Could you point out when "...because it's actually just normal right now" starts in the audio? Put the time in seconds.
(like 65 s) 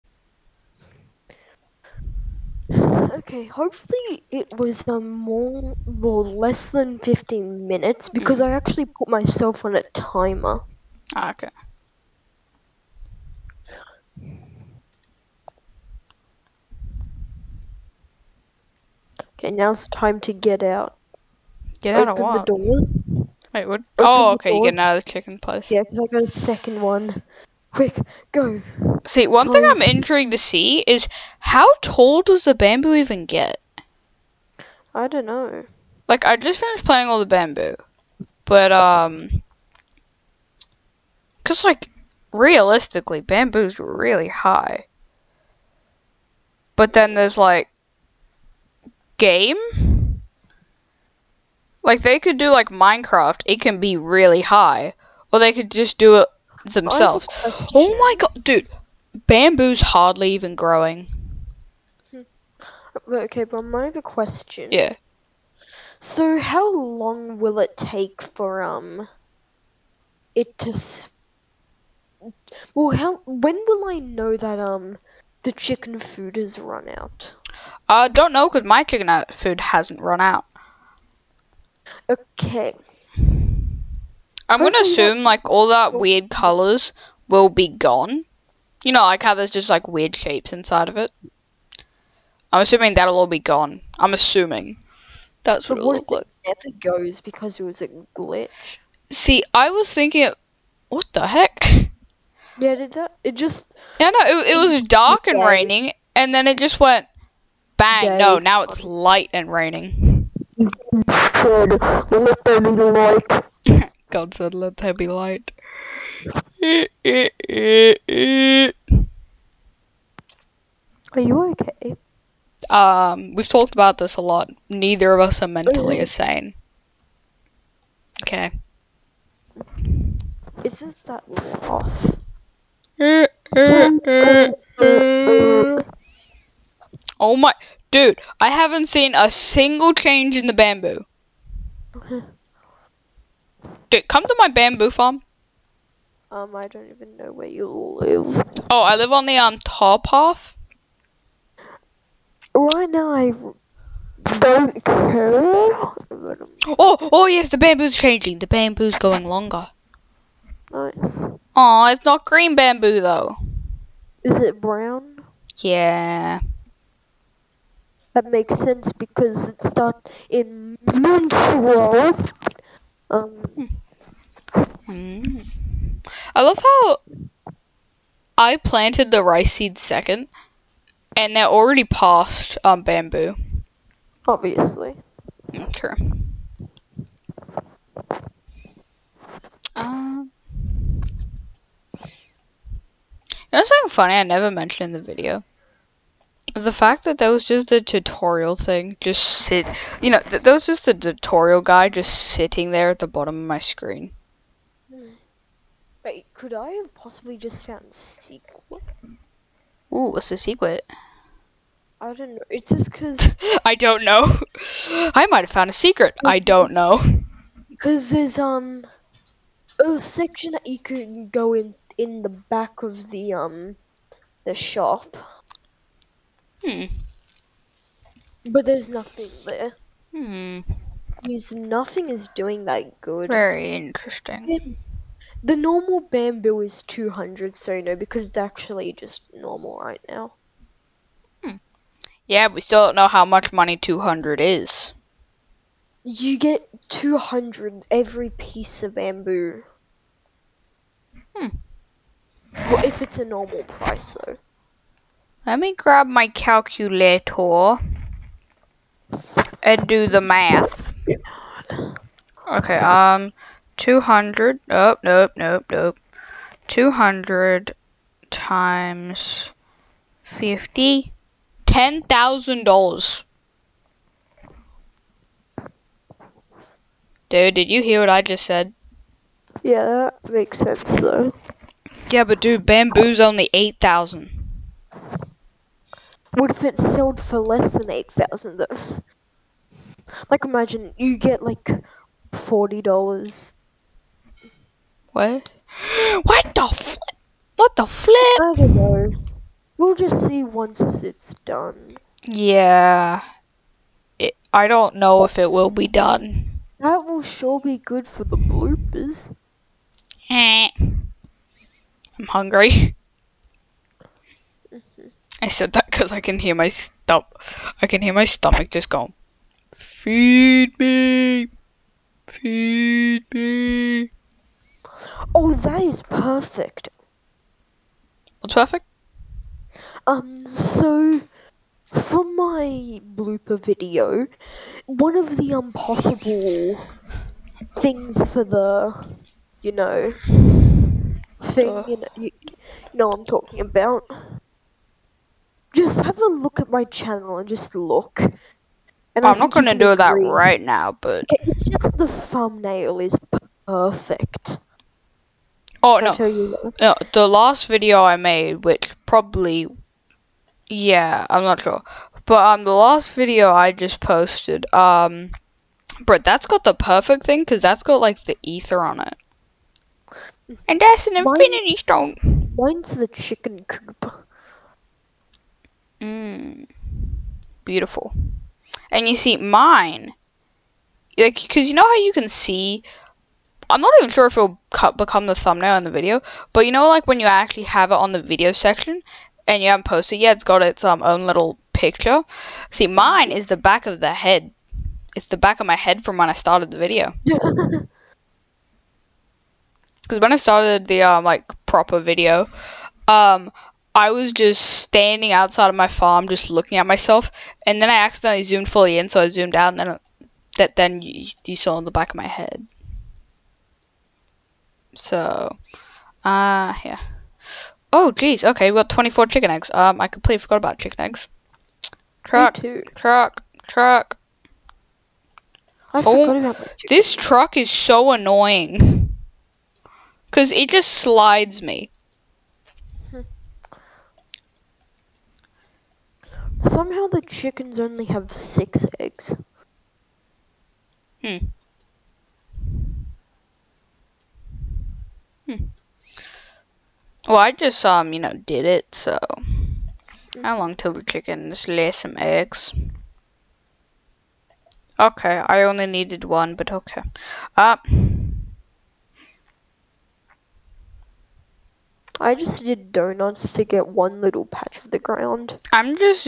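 237 s.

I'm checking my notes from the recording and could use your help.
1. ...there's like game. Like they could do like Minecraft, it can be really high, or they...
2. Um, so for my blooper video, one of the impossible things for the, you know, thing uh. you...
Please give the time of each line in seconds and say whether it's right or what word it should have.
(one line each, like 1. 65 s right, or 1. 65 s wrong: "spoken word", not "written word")
1. 47 s right
2. 330 s right.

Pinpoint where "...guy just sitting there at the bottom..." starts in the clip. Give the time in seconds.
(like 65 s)
201 s.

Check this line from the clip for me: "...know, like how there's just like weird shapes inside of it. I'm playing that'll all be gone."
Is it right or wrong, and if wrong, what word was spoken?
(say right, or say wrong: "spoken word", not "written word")
wrong: "assuming", not "playing".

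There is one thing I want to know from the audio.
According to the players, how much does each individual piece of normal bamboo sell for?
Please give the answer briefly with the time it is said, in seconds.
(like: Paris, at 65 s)
200, at 246 s.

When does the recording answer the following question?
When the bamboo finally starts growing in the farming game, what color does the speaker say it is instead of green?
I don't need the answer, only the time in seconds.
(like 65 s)
164 s.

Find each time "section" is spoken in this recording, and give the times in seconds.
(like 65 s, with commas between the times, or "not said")
219 s, 388 s.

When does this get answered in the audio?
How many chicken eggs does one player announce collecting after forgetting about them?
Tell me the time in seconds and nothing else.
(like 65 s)
418 s.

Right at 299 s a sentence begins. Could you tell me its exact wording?
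We'll just see once it's done.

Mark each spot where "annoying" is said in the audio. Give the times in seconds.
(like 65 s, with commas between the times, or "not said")
428 s.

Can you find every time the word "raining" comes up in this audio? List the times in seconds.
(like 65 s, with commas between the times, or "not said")
105 s, 109 s.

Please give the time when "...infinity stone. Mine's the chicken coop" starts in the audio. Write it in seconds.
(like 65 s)
371 s.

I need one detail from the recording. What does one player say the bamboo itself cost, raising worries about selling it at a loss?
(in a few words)
8,000.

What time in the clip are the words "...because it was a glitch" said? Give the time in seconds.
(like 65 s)
97 s.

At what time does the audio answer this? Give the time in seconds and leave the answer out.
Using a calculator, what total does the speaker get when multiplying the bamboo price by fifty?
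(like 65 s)
271 s.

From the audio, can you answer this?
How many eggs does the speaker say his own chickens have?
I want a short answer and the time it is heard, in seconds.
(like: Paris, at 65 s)
Six, at 438 s.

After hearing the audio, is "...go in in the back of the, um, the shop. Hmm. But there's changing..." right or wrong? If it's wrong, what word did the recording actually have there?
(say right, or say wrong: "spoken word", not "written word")
wrong: "nothing", not "changing".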